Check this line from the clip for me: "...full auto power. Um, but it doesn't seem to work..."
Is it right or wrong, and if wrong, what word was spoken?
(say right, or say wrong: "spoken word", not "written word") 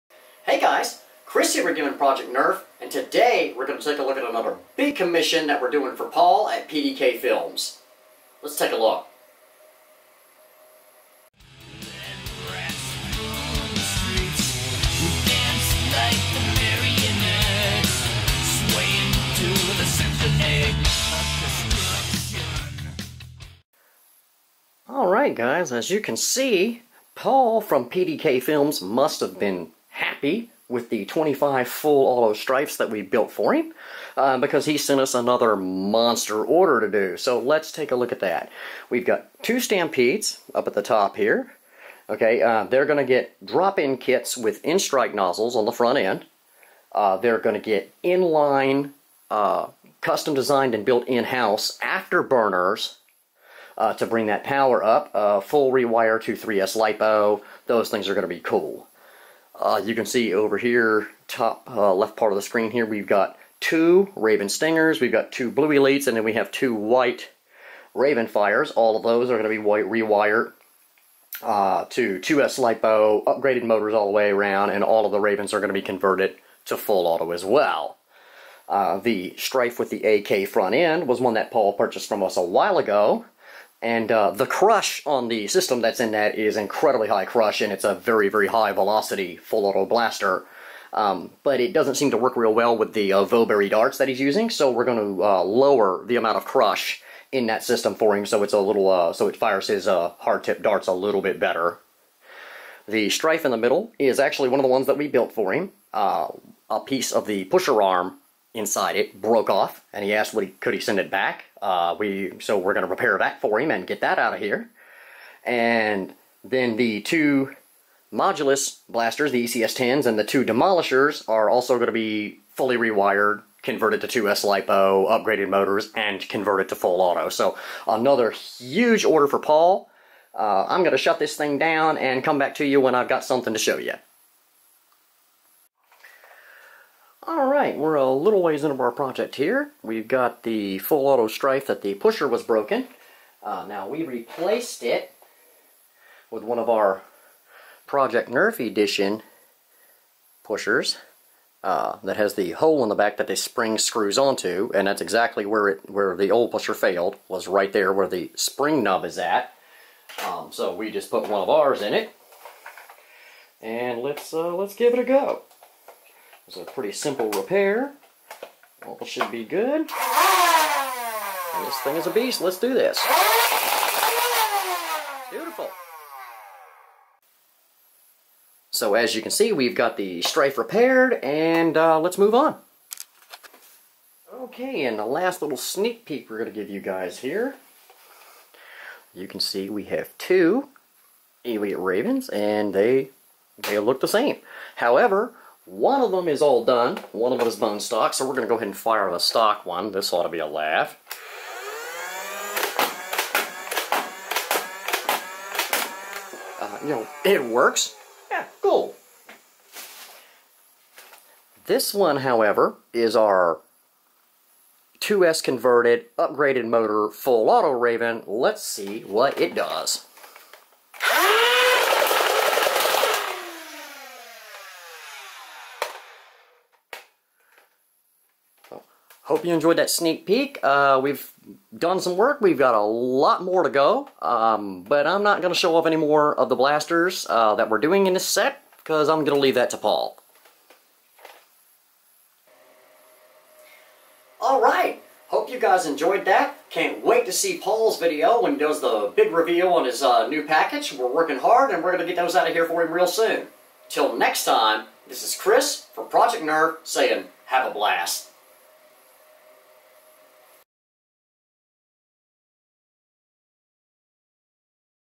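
wrong: "blaster", not "power".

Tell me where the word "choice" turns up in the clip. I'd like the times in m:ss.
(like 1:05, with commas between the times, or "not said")
not said.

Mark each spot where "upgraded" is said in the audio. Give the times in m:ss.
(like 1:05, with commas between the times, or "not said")
1:13, 2:05, 3:36.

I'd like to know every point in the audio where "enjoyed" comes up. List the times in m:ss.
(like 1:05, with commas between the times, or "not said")
3:49, 4:05.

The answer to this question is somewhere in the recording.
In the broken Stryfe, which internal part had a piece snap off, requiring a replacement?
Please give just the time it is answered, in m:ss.
1:47.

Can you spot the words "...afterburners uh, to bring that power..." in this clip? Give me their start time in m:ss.
0:51.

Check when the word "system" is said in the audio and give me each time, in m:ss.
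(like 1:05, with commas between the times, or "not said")
1:25, 1:37.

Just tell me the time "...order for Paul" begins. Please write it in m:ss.
2:09.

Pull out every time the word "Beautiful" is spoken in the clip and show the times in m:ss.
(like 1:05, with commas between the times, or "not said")
2:55.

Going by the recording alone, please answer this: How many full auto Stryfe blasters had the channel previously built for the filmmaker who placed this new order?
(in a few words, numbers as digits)
25.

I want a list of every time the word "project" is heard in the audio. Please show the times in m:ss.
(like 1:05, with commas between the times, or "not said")
0:01, 2:18, 2:27, 4:16.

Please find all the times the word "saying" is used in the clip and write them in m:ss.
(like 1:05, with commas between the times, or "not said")
4:16.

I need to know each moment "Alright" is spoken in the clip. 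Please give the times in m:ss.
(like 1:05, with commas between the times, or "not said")
0:24, 2:17, 4:04.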